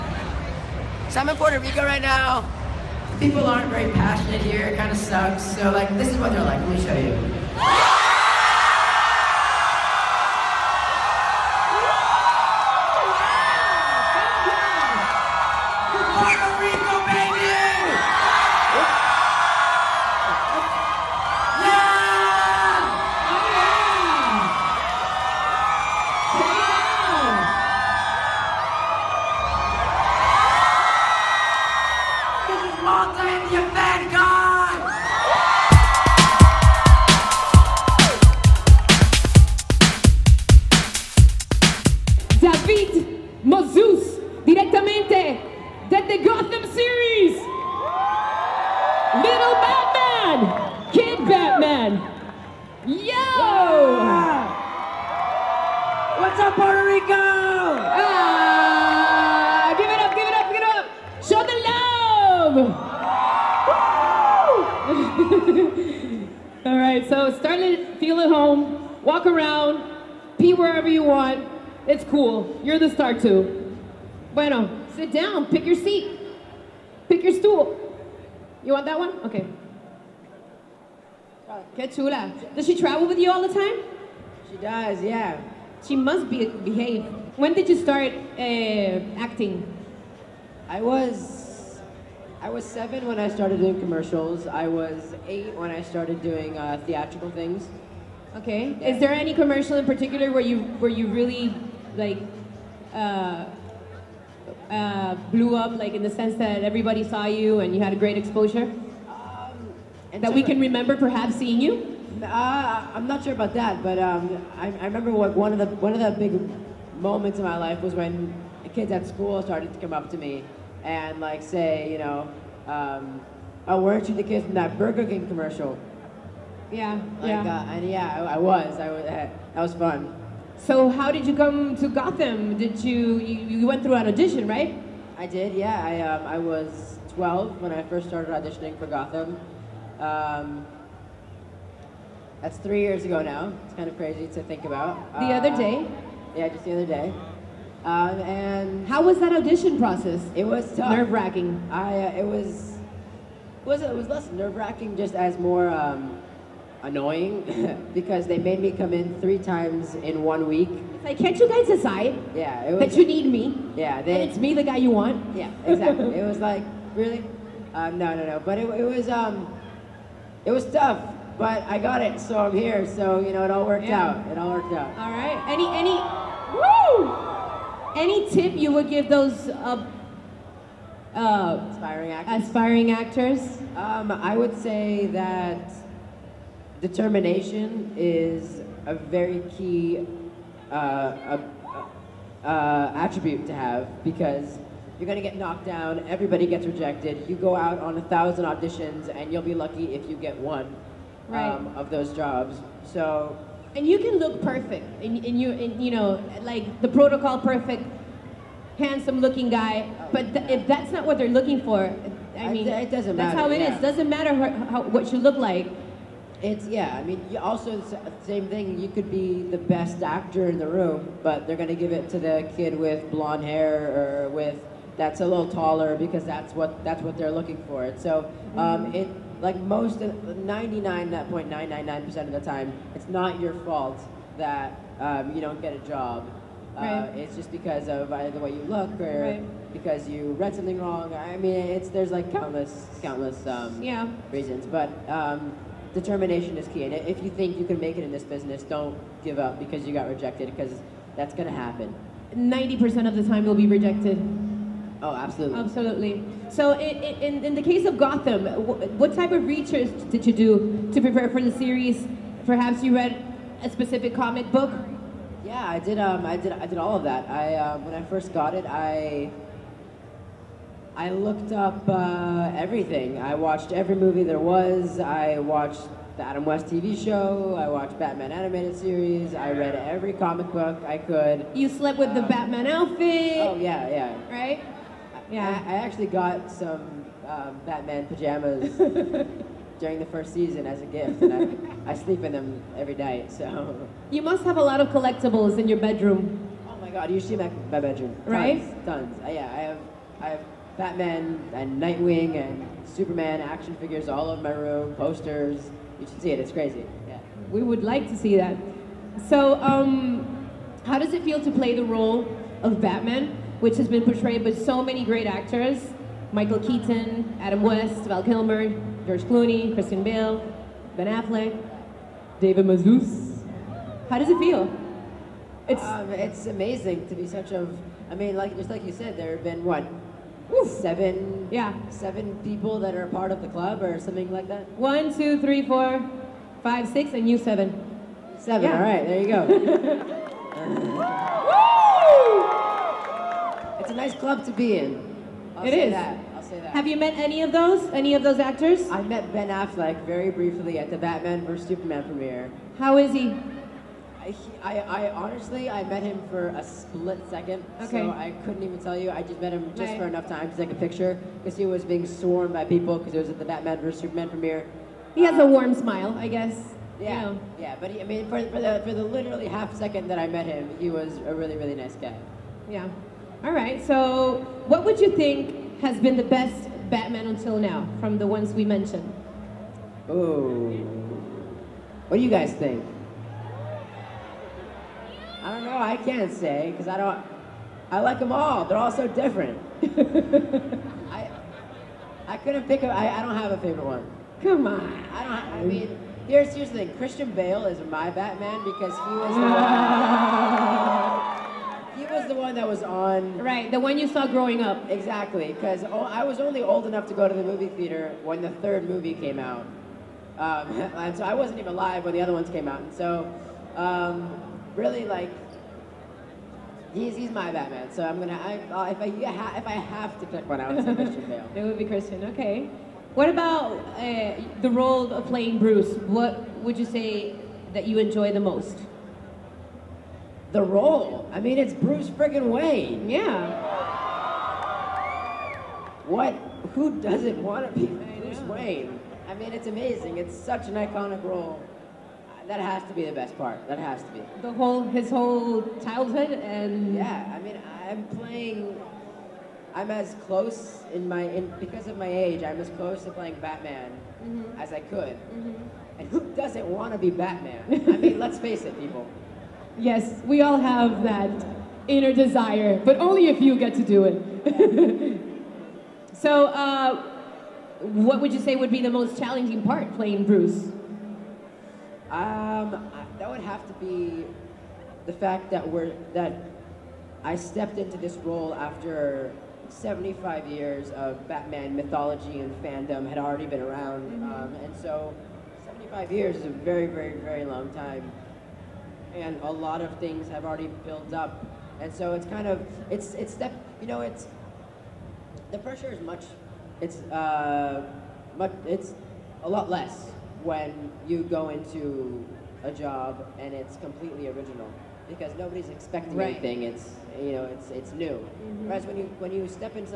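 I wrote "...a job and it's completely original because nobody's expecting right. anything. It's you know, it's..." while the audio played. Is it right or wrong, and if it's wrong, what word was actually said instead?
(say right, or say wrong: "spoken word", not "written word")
right.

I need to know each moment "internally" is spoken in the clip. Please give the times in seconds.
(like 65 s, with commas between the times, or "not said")
not said.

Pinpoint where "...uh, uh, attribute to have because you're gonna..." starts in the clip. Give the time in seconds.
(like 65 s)
190 s.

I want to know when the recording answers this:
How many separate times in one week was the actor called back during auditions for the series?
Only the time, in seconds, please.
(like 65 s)
159 s.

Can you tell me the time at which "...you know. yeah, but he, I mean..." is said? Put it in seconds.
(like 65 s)
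367 s.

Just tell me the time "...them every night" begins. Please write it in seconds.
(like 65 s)
292 s.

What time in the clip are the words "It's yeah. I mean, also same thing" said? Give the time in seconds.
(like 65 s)
216 s.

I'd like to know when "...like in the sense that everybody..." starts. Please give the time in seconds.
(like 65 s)
105 s.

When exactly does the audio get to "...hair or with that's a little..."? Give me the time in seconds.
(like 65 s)
223 s.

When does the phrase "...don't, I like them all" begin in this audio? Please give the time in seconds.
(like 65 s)
386 s.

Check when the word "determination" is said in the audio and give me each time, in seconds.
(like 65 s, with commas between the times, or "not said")
186 s, 245 s.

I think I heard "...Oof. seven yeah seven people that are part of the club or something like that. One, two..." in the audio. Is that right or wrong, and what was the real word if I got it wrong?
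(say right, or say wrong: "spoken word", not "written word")
right.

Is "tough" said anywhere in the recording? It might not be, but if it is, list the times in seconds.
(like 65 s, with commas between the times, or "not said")
150 s, 170 s.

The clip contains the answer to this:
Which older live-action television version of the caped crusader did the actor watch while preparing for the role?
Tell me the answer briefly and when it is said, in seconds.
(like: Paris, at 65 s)
The Adam West TV show, at 276 s.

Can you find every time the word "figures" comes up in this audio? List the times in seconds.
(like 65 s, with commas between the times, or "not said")
303 s.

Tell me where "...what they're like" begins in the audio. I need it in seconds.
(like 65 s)
6 s.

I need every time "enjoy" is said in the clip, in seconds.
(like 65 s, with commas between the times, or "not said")
427 s.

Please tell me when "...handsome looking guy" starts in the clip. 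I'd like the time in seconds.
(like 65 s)
208 s.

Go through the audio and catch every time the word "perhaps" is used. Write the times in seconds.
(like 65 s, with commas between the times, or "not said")
110 s, 262 s.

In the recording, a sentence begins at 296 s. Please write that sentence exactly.
Oh my god, usually my, my bedroom, tons, right?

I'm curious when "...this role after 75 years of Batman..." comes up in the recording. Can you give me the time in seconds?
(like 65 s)
477 s.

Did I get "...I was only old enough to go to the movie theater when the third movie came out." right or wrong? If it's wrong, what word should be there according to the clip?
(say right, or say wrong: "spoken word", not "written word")
right.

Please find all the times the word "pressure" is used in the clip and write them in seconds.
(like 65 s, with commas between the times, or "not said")
495 s.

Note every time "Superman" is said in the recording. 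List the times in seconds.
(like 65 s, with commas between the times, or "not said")
302 s, 351 s, 363 s.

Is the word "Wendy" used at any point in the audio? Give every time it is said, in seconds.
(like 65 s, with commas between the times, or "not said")
not said.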